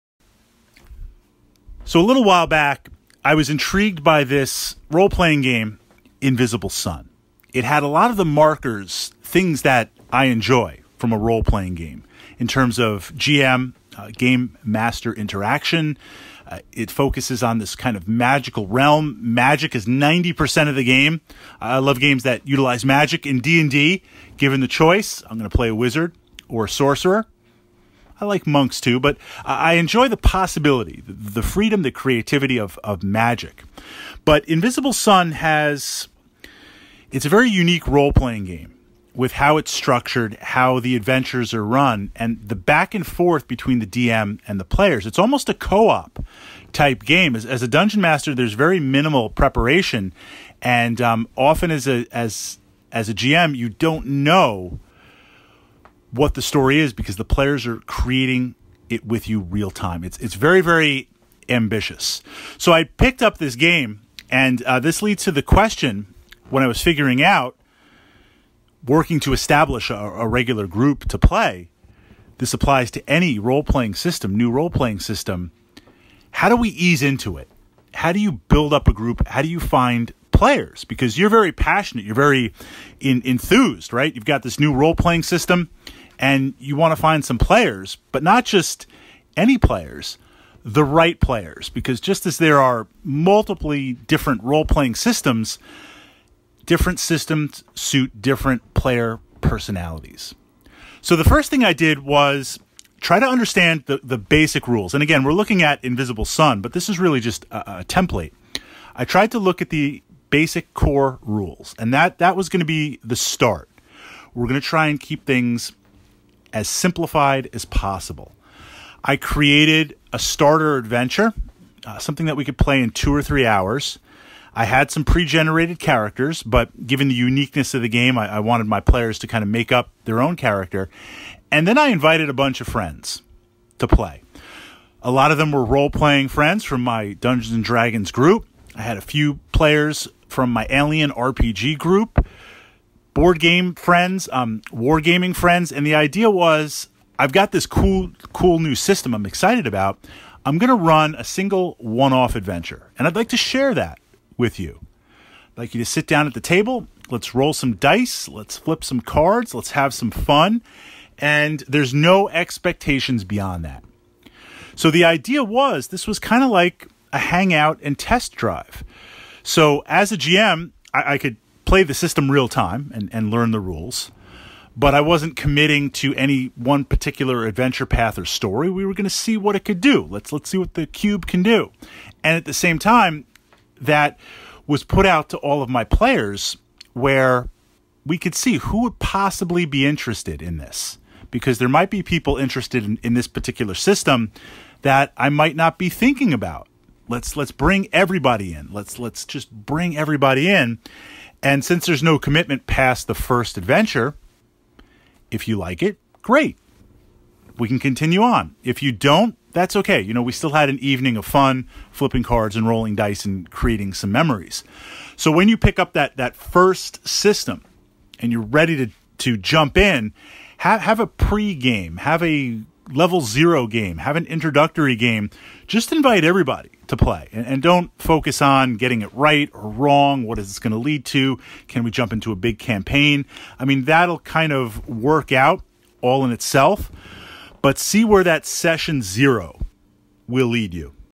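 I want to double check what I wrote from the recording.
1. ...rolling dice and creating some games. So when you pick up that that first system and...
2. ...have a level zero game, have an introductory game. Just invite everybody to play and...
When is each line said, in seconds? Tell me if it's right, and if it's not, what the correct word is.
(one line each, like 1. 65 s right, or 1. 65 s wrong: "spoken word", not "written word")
1. 212 s wrong: "memories", not "games"
2. 221 s right.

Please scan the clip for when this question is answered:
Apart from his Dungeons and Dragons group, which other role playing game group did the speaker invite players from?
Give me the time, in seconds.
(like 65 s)
140 s.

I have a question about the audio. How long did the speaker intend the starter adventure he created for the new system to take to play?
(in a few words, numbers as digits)
Two or three hours.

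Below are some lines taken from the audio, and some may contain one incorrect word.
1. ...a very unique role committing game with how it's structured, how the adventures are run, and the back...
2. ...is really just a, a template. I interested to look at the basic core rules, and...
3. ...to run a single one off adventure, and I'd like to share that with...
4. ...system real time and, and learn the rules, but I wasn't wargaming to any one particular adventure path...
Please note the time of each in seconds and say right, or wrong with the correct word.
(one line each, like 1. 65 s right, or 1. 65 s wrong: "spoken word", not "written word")
1. 37 s wrong: "playing", not "committing"
2. 106 s wrong: "tried", not "interested"
3. 150 s right
4. 171 s wrong: "committing", not "wargaming".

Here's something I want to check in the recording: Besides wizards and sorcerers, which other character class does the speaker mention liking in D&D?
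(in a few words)
Monks.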